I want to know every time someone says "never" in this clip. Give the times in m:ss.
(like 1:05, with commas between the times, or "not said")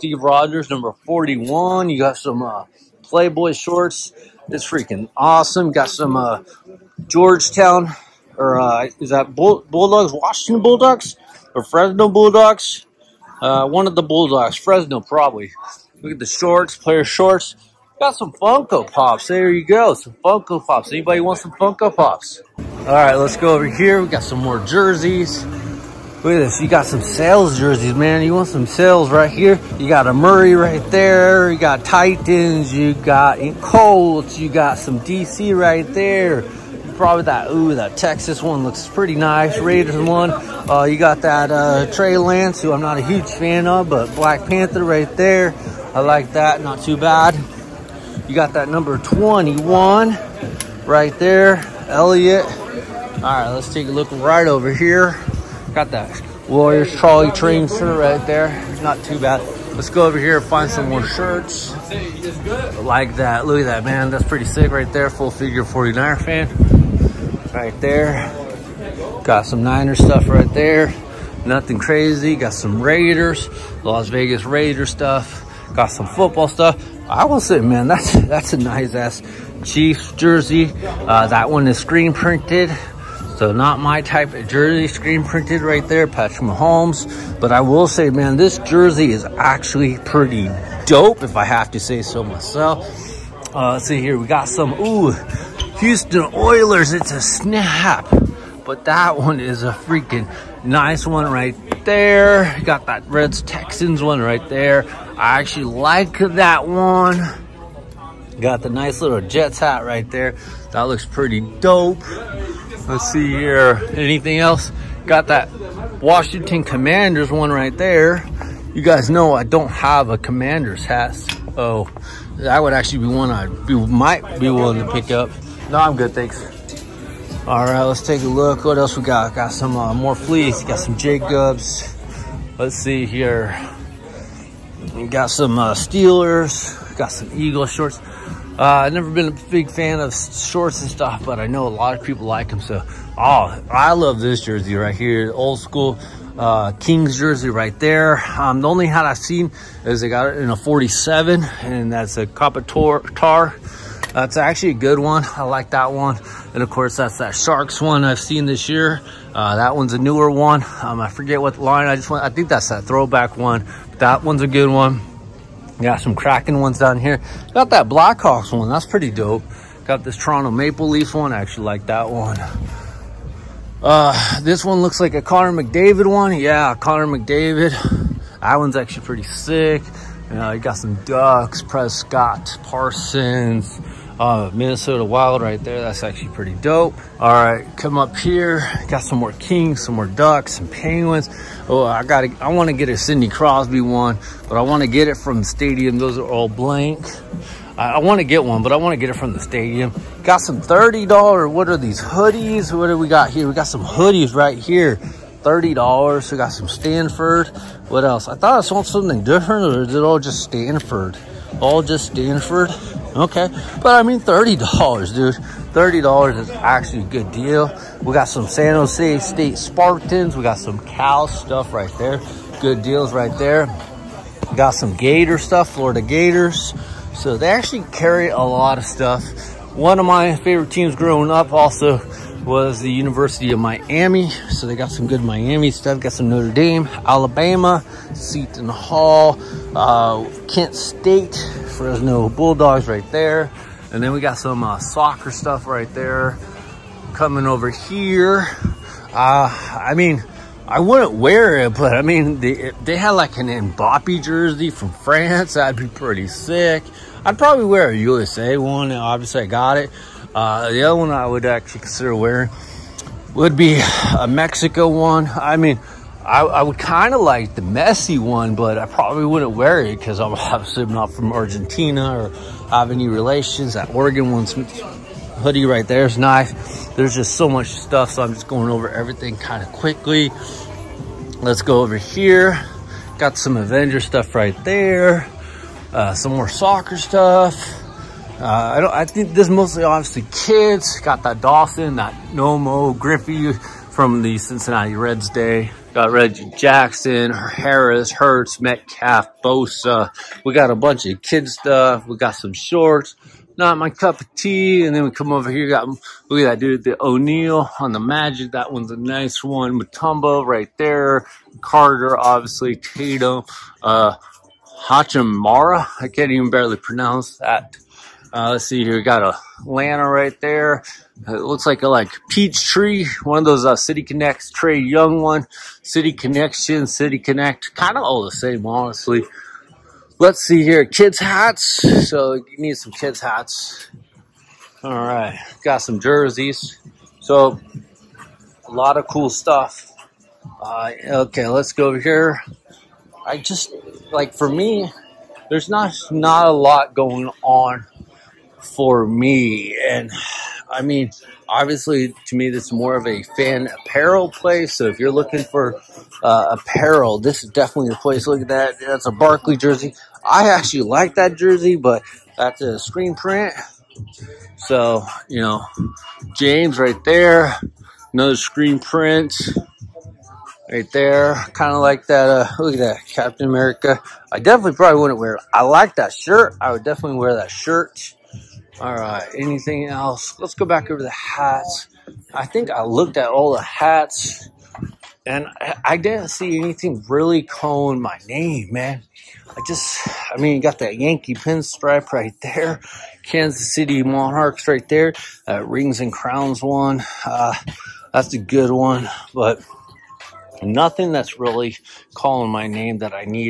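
2:18.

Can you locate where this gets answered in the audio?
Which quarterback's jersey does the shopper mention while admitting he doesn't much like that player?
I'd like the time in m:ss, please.
0:41.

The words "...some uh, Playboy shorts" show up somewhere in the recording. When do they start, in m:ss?
0:02.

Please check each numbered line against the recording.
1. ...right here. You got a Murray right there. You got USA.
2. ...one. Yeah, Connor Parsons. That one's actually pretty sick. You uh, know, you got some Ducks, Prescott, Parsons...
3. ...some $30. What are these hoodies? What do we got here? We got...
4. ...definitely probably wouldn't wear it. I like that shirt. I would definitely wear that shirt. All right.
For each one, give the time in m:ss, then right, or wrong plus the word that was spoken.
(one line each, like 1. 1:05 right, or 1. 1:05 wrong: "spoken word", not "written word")
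1. 0:29 wrong: "Titans", not "USA"
2. 2:56 wrong: "McDavid", not "Parsons"
3. 3:20 right
4. 6:14 right.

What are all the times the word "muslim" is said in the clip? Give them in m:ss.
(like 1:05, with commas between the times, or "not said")
not said.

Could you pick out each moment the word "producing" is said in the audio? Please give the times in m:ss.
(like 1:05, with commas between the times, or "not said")
not said.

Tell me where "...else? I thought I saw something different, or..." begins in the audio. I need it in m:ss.
3:28.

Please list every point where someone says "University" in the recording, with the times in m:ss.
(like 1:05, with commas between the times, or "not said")
3:52.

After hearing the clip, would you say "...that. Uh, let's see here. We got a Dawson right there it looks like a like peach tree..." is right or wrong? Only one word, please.
wrong.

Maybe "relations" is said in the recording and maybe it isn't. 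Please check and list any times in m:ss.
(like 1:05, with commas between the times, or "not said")
4:33.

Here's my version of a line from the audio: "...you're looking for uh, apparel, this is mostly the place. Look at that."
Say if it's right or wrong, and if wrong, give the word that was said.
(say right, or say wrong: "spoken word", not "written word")
wrong: "definitely", not "mostly".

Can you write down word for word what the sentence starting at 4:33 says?
That Oregon one's hoodie right there is nice.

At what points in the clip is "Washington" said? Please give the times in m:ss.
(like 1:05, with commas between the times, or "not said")
0:10, 1:55.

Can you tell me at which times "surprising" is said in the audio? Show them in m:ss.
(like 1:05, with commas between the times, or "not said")
not said.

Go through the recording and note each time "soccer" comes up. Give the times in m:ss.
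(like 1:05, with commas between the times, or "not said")
4:04, 4:46.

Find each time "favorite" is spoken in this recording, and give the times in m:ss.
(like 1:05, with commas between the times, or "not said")
3:50.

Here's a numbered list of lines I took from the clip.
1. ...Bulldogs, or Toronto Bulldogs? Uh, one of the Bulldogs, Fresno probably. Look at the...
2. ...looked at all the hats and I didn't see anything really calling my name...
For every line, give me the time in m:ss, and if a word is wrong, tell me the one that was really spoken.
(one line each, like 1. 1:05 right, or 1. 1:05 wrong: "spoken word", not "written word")
1. 0:10 wrong: "Fresno", not "Toronto"
2. 6:22 right.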